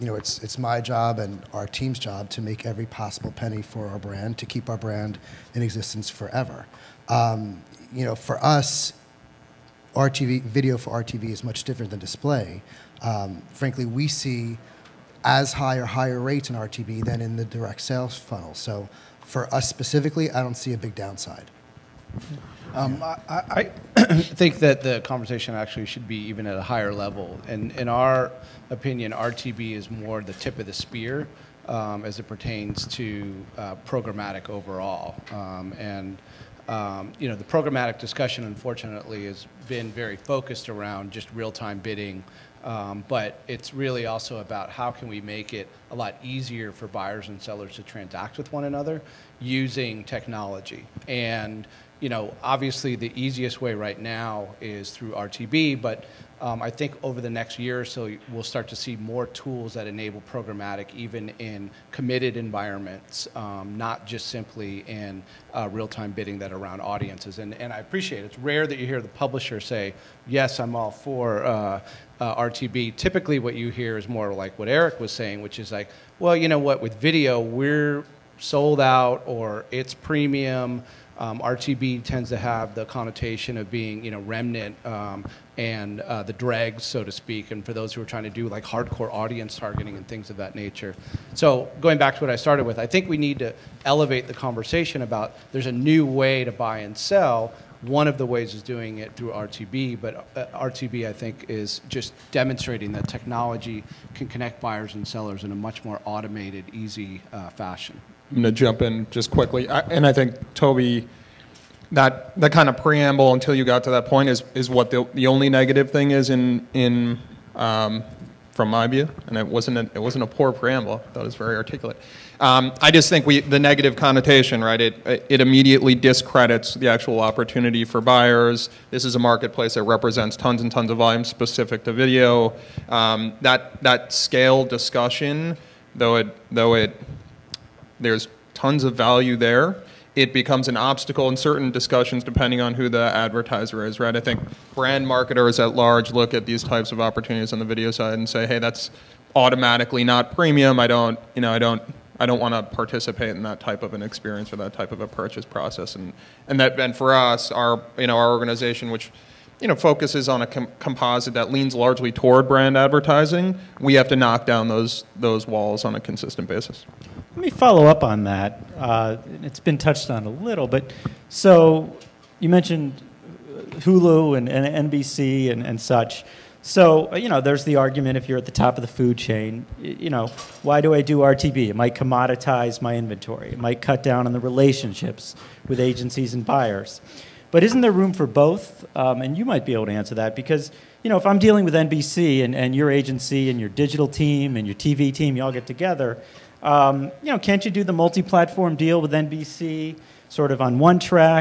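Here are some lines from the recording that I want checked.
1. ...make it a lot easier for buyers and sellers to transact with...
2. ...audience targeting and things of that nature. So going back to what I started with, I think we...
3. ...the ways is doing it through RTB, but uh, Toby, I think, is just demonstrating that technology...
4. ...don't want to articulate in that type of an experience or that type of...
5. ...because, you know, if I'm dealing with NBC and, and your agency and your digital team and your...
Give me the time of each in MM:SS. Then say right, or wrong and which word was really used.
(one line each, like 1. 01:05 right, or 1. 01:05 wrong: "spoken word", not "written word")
1. 00:45 right
2. 01:29 right
3. 01:38 wrong: "RTB", not "Toby"
4. 02:32 wrong: "participate", not "articulate"
5. 03:10 right.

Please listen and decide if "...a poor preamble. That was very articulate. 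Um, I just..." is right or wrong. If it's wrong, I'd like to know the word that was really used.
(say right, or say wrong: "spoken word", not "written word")
right.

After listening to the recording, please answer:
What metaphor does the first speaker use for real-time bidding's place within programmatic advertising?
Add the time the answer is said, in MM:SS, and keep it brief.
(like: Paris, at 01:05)
The tip of the spear, at 00:30.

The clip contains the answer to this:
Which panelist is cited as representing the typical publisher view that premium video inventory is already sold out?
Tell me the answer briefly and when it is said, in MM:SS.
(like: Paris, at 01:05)
Eric, at 01:14.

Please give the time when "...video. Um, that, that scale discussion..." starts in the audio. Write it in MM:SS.
02:11.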